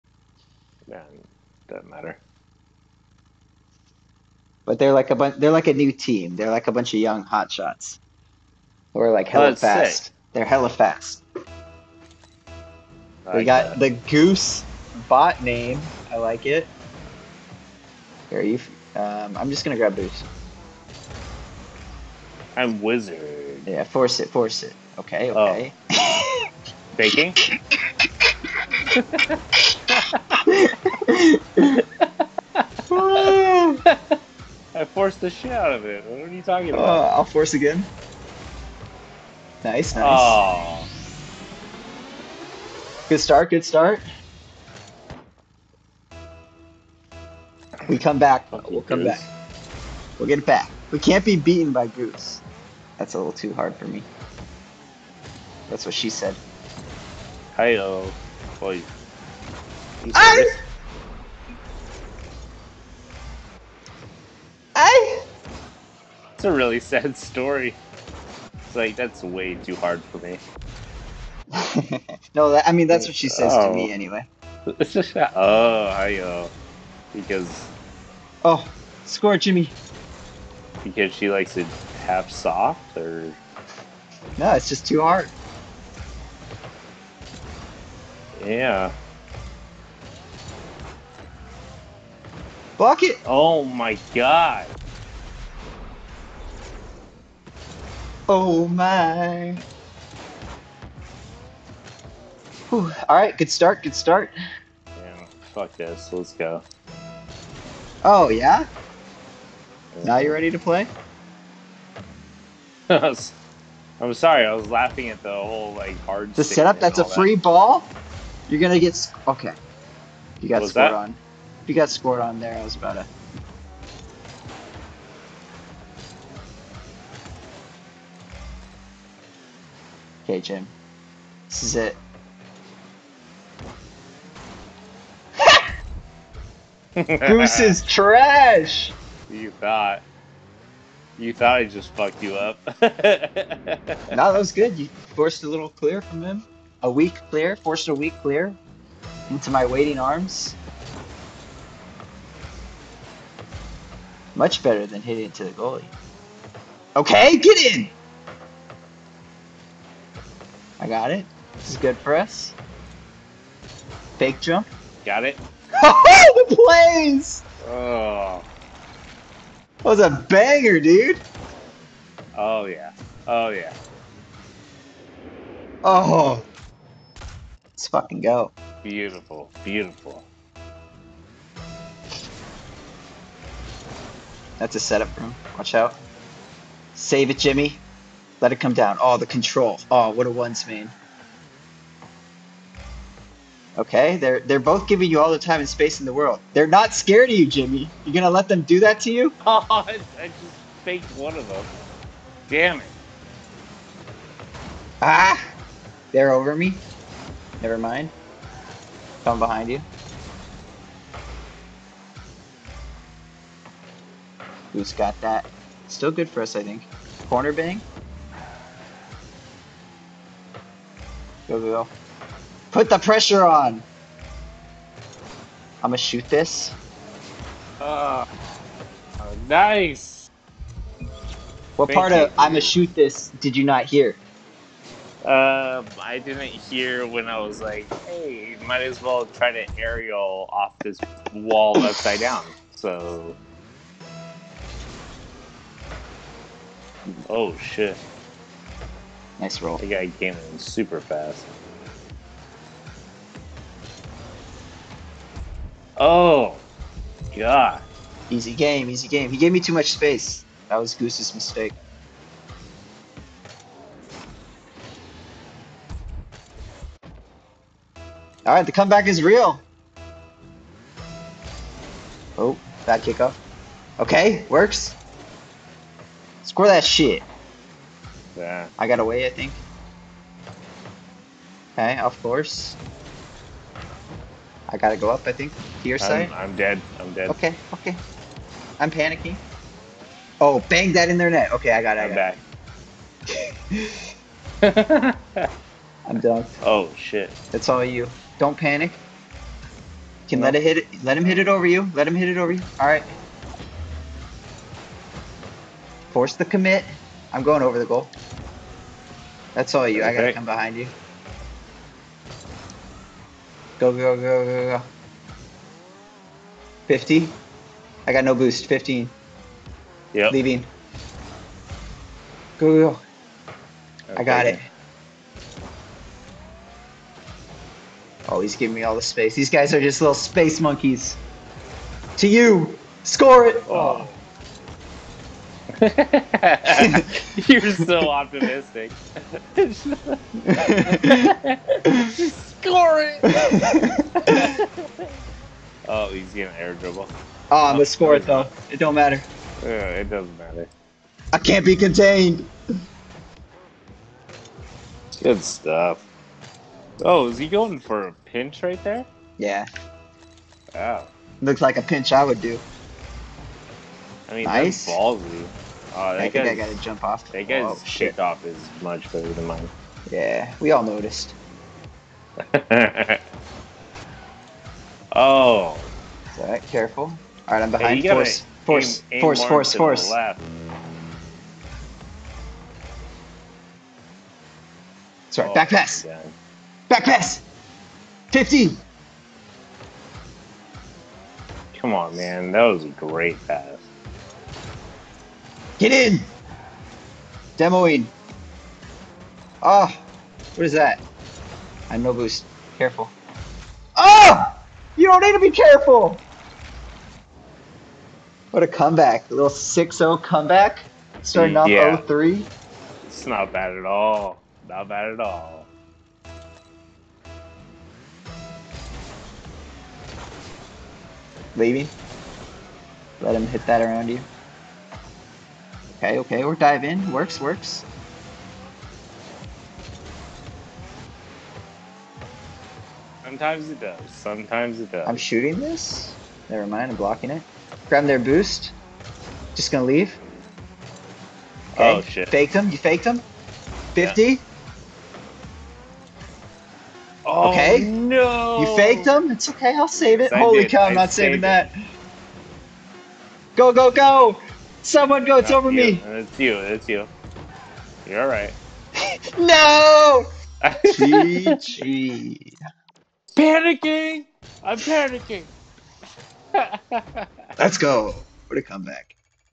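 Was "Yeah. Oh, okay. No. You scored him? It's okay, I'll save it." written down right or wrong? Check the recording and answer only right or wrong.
wrong.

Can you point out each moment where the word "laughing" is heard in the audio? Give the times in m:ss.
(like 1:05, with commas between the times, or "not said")
1:54.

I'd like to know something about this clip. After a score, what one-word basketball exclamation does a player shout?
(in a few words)
Bucket.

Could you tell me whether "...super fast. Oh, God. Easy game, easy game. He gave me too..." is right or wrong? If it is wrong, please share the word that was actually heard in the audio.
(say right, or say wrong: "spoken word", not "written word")
right.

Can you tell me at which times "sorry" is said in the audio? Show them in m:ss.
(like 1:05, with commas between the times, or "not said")
1:54, 6:25.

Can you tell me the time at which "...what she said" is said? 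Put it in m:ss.
0:55.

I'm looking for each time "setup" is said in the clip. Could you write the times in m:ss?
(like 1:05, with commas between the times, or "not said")
1:56, 3:04.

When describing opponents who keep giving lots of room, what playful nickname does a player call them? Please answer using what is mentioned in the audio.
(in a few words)
space monkeys.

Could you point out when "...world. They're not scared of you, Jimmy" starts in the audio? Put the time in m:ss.
3:16.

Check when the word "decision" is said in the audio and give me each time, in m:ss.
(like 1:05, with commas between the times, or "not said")
not said.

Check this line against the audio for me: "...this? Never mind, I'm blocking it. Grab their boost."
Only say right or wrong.
right.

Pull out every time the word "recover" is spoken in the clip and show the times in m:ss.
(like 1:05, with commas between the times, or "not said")
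not said.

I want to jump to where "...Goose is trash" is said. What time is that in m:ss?
2:17.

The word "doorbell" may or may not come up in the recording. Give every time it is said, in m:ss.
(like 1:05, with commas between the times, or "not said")
not said.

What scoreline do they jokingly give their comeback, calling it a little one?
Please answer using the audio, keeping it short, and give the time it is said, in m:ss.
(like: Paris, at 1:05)
6-0, at 6:49.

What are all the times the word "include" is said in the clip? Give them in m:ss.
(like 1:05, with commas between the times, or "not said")
not said.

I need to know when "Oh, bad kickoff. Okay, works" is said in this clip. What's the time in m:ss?
4:32.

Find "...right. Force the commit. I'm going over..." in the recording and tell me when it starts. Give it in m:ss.
5:02.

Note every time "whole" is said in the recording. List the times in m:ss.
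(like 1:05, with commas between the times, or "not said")
1:55.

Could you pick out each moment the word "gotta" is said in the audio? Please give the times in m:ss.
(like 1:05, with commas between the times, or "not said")
4:44, 5:10.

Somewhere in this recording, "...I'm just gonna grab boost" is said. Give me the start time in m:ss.
0:19.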